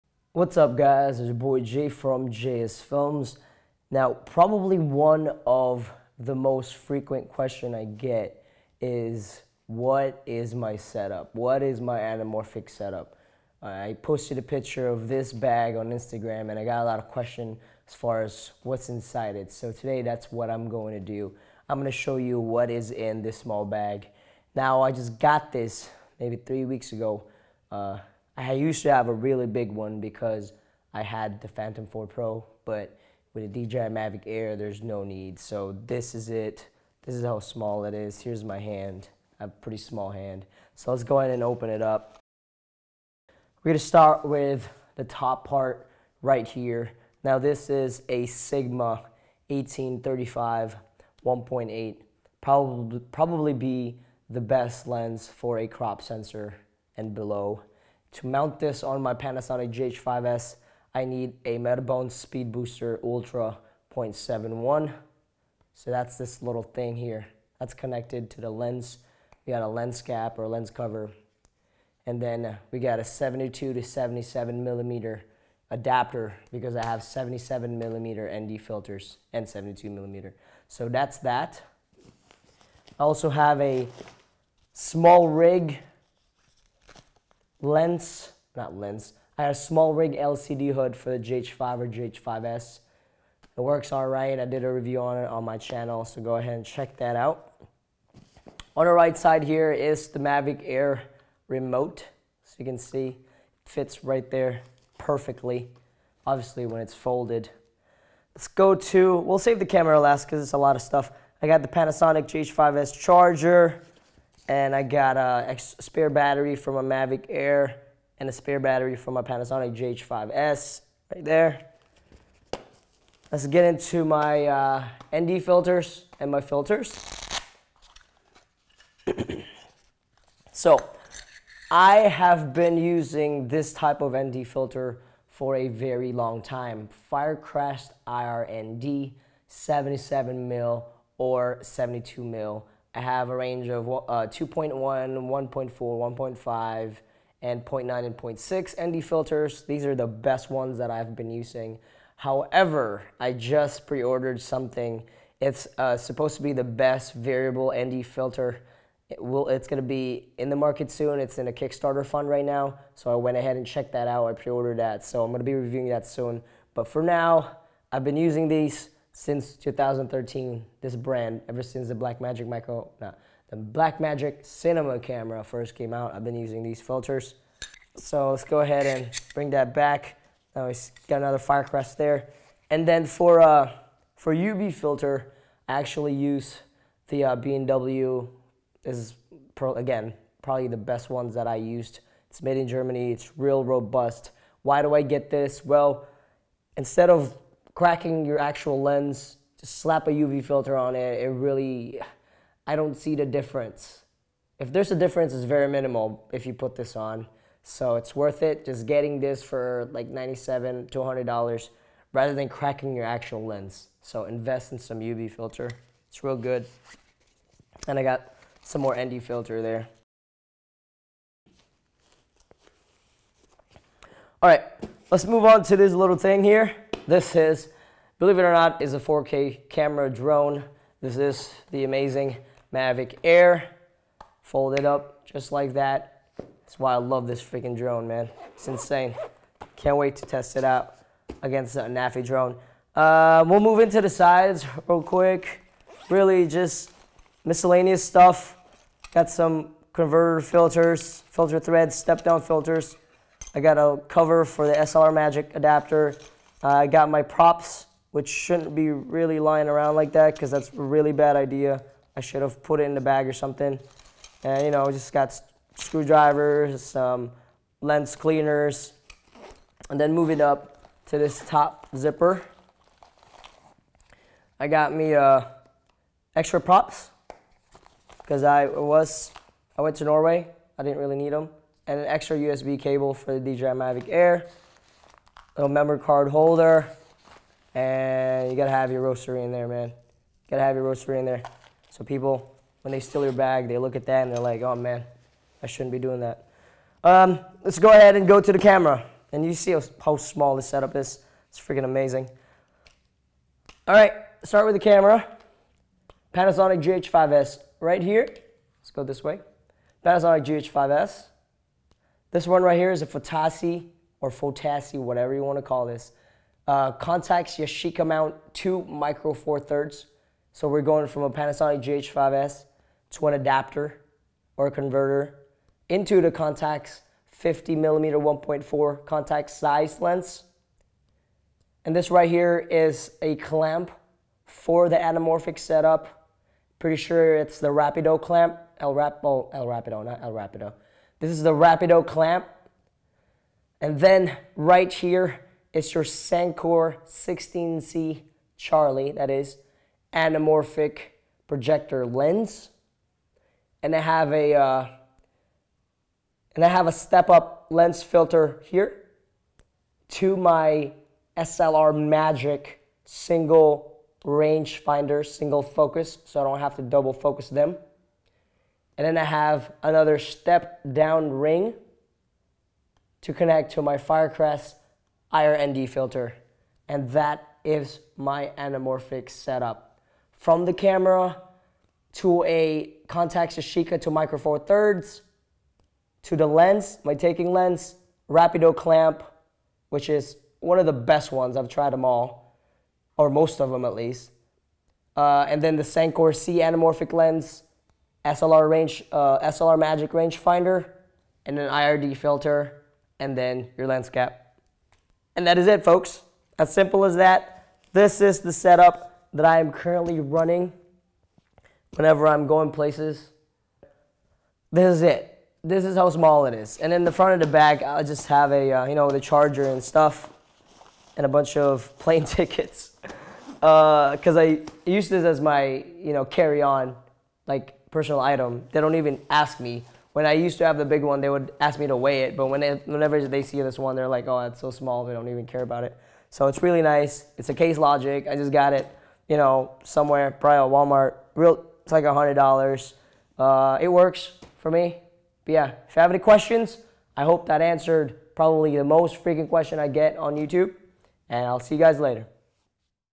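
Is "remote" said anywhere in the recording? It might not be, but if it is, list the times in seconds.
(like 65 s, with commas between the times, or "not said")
101 s.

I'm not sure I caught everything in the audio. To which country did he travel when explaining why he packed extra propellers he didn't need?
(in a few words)
Norway.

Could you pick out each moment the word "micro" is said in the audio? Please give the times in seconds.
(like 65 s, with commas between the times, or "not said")
172 s, 318 s, 384 s.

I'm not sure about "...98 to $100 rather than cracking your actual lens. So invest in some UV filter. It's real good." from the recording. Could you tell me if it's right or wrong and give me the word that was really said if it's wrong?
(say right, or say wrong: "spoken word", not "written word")
wrong: "97", not "98".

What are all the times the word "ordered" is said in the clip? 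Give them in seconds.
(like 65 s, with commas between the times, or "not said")
153 s, 164 s.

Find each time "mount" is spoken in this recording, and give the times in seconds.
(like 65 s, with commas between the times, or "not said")
58 s, 318 s.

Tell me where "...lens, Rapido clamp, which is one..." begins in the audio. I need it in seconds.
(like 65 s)
387 s.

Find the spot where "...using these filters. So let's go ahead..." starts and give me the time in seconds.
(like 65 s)
176 s.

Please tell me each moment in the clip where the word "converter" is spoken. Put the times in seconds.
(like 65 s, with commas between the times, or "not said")
249 s, 324 s.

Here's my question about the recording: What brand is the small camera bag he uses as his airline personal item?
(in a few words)
Case Logic.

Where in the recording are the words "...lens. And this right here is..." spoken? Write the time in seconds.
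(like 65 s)
329 s.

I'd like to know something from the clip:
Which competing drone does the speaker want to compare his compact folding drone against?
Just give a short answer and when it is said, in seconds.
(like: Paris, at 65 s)
Anafi, at 241 s.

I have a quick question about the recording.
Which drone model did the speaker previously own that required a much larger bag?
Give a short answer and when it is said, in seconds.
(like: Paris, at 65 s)
Phantom 4 Pro, at 31 s.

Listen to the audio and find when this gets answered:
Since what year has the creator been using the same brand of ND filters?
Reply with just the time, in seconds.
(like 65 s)
169 s.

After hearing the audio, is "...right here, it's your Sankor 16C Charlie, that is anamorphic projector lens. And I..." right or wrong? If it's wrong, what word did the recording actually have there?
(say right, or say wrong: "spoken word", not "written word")
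right.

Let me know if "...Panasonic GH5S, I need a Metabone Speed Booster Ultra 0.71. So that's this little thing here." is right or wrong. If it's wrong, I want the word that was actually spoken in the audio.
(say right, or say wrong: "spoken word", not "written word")
right.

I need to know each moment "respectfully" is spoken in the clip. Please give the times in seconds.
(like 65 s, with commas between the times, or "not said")
not said.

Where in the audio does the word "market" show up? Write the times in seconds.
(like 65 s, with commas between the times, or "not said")
160 s.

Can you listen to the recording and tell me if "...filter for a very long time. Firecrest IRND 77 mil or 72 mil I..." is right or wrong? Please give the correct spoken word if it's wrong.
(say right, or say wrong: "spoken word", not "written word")
right.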